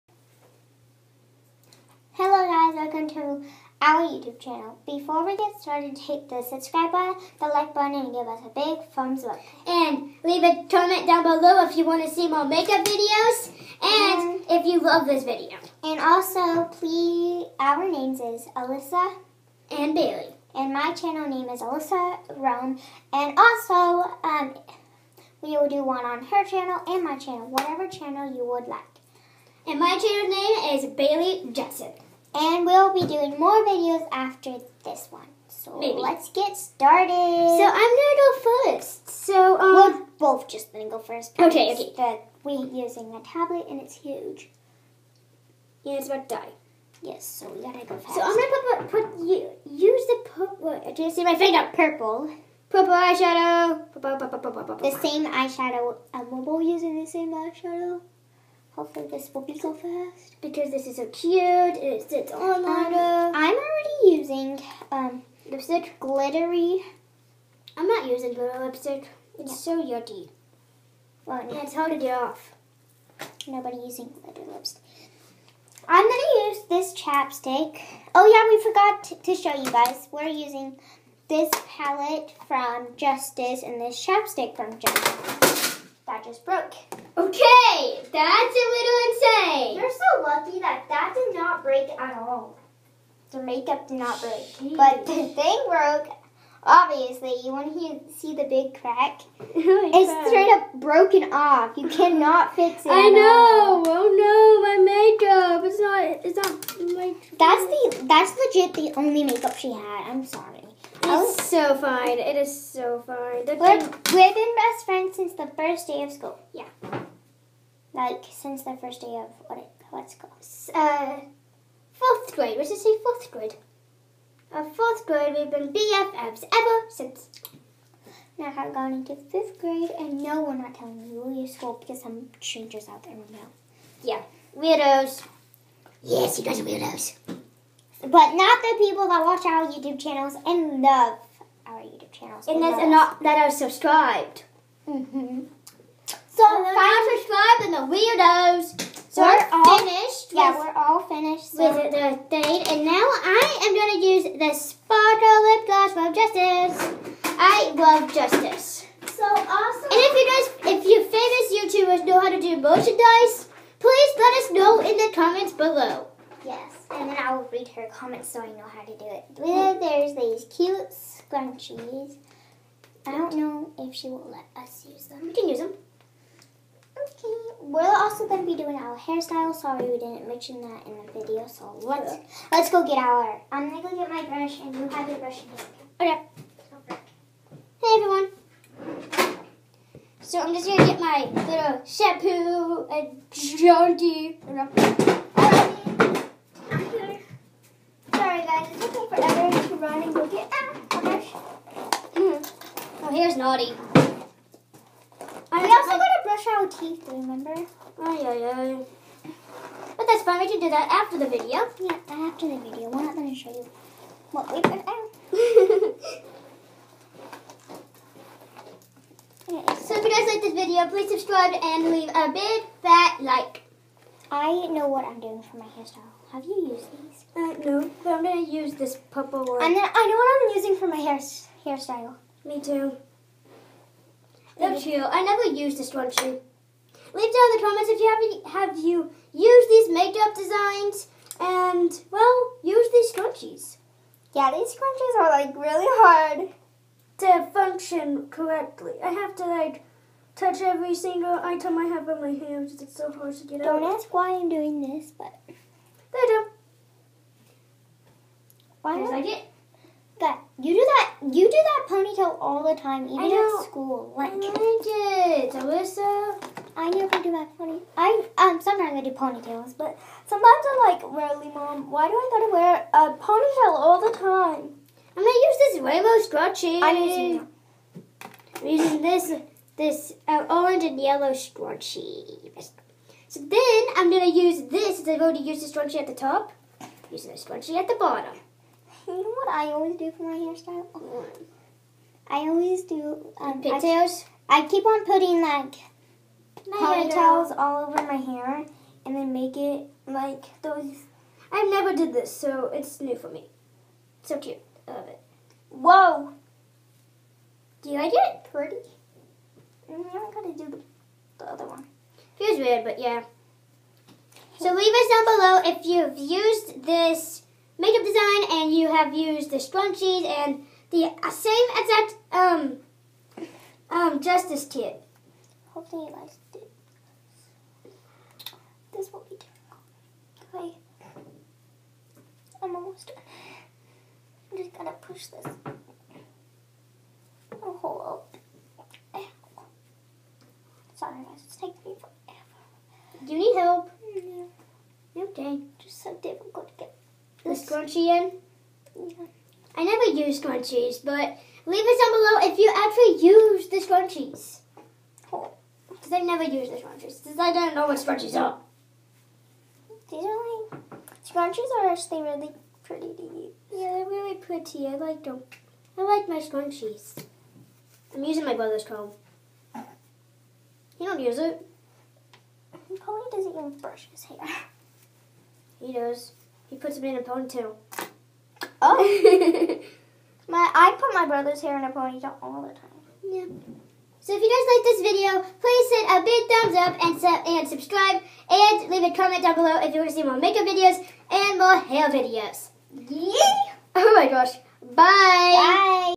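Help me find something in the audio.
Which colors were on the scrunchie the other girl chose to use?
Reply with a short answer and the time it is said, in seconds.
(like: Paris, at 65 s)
Orange and yellow, at 280 s.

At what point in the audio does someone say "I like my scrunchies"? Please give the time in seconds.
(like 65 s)
365 s.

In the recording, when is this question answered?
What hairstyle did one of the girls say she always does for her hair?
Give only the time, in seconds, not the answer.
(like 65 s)
293 s.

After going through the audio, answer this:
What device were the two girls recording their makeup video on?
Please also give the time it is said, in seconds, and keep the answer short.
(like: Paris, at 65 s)
Tablet, at 43 s.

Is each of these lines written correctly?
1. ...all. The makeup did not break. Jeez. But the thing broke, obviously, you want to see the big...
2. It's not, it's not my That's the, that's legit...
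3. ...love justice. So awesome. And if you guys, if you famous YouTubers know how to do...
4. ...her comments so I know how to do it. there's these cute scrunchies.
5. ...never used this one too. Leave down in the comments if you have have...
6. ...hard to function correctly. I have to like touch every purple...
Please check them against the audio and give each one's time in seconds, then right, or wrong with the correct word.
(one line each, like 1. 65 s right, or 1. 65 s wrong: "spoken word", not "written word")
1. 92 s right
2. 105 s right
3. 157 s right
4. 167 s right
5. 235 s right
6. 245 s wrong: "single", not "purple".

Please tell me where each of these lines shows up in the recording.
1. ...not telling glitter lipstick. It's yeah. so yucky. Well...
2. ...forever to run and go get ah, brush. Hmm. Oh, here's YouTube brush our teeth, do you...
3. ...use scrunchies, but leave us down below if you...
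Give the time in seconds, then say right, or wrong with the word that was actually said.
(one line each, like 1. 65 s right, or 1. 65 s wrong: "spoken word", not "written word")
1. 67 s wrong: "using", not "telling"
2. 199 s wrong: "Naughty", not "YouTube"
3. 350 s right.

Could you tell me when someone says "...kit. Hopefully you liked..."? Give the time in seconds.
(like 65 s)
324 s.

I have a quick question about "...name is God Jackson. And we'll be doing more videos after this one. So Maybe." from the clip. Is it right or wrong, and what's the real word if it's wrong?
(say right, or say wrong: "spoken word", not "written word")
wrong: "Bailey", not "God".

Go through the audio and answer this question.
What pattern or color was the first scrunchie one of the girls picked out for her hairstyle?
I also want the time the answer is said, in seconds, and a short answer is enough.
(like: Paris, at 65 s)
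Rainbow, at 275 s.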